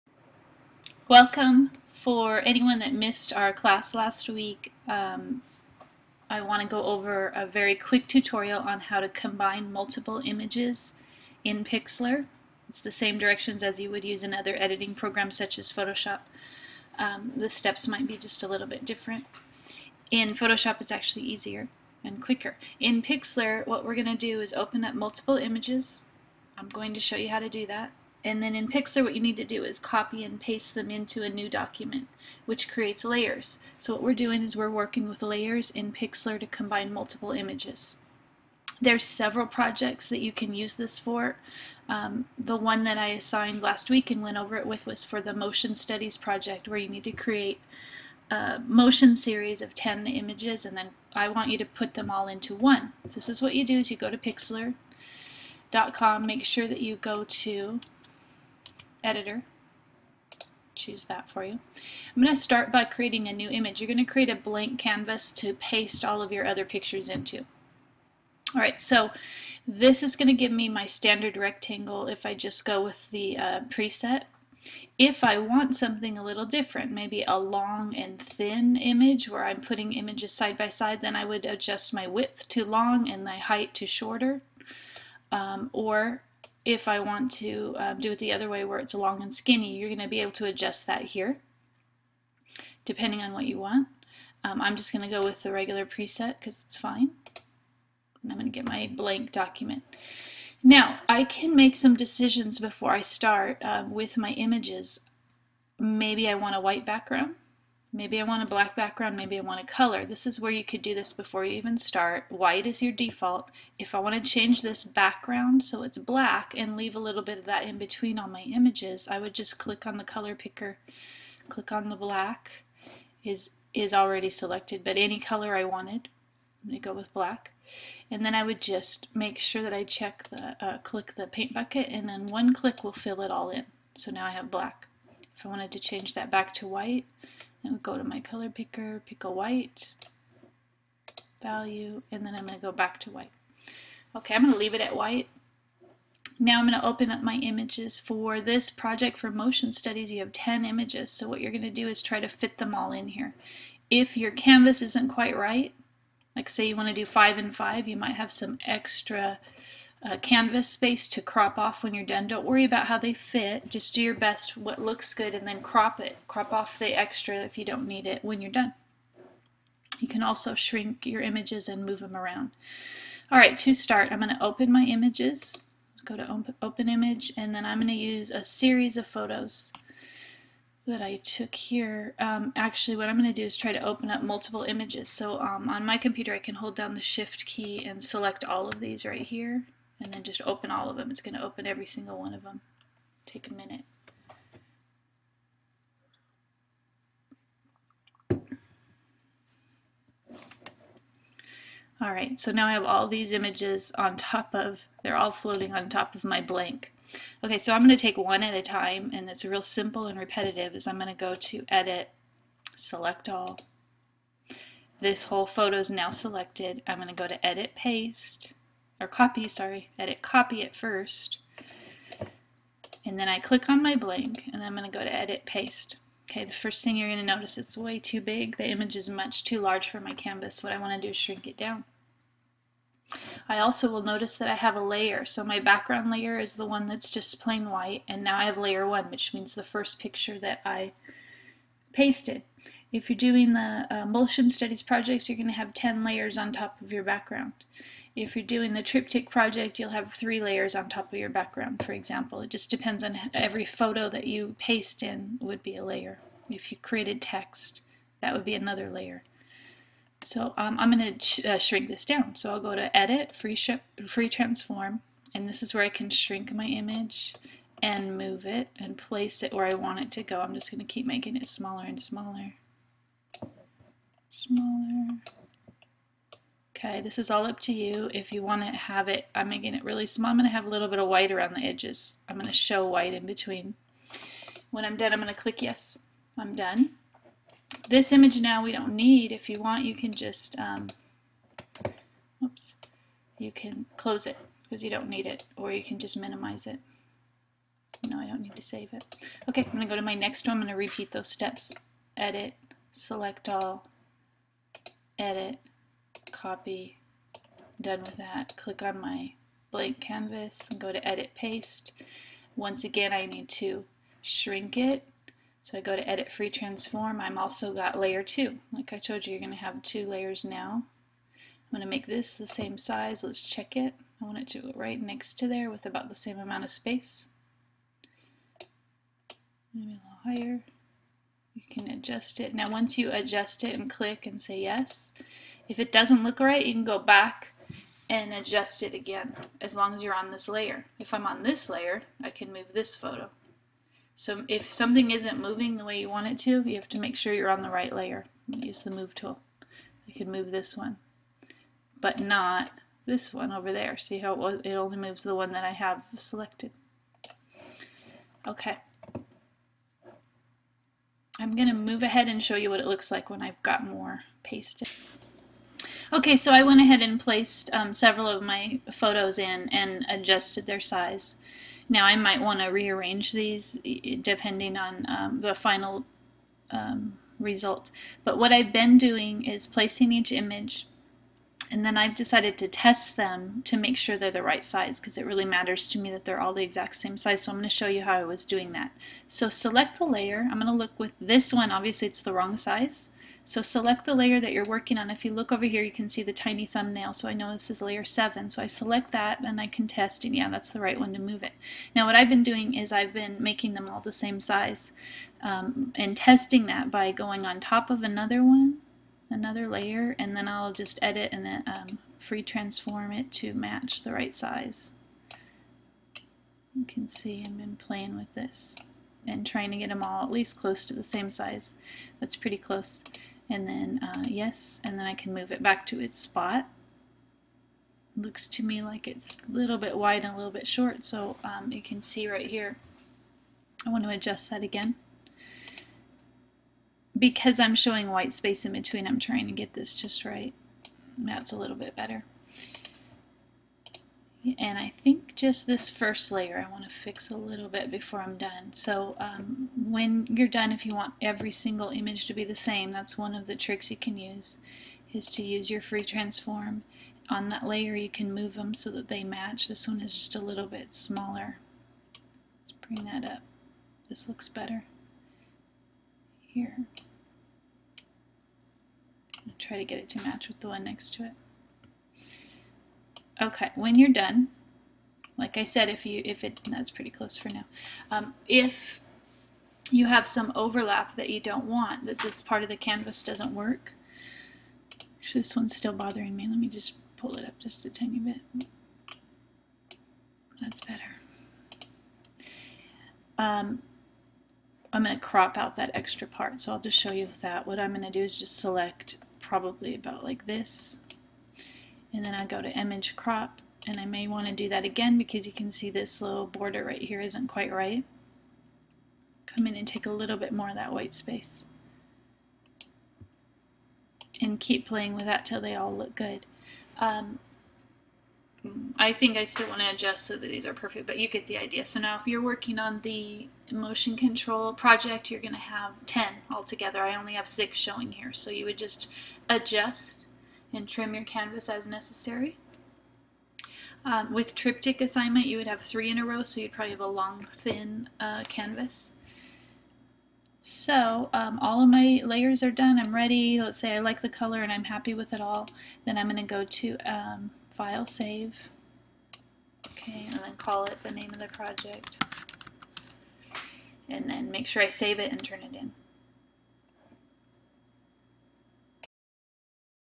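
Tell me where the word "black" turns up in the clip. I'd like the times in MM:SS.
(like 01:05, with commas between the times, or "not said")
01:48, 01:55, 02:01, 02:07, 02:14.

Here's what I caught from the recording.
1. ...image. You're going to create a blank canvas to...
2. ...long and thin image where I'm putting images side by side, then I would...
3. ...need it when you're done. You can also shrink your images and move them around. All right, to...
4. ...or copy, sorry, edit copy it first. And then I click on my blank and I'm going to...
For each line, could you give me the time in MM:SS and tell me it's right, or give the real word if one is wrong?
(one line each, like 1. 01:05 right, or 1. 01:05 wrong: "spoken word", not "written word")
1. 01:03 right
2. 01:17 right
3. 02:47 right
4. 03:39 right.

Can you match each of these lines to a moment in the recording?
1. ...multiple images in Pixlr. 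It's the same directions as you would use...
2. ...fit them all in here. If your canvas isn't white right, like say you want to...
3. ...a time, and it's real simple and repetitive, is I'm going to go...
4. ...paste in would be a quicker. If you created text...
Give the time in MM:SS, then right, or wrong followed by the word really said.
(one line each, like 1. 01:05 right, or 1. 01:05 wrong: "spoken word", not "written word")
1. 00:09 right
2. 02:32 wrong: "quite", not "white"
3. 03:28 right
4. 04:14 wrong: "layer", not "quicker".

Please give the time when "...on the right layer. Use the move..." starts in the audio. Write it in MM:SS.
05:47.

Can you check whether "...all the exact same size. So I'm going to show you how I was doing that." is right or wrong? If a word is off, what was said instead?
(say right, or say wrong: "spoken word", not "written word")
right.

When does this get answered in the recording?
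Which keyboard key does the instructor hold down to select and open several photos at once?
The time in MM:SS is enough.
03:07.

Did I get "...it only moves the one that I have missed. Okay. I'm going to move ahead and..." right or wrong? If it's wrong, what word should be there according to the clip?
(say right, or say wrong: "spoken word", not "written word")
wrong: "selected", not "missed".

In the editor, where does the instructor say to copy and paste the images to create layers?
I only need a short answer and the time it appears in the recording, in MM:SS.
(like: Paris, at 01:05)
a new document, at 00:31.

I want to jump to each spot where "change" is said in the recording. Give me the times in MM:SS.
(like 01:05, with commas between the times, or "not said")
01:54, 02:15.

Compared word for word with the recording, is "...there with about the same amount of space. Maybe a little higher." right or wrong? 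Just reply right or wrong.
right.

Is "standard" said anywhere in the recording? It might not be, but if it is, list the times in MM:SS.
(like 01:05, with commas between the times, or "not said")
01:10.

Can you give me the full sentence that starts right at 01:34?
Um, I'm just going to go with the regular preset because it's fine.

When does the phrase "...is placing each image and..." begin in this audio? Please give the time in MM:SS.
06:19.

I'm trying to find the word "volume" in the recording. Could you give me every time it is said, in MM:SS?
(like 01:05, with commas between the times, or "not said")
not said.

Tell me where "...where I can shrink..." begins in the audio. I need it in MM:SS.
04:25.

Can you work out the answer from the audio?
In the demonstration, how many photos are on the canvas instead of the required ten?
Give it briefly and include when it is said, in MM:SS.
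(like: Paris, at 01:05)
6, at 08:47.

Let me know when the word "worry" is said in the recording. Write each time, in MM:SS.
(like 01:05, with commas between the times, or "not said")
02:42.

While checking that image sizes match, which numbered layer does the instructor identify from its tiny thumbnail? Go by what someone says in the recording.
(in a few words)
layer 7.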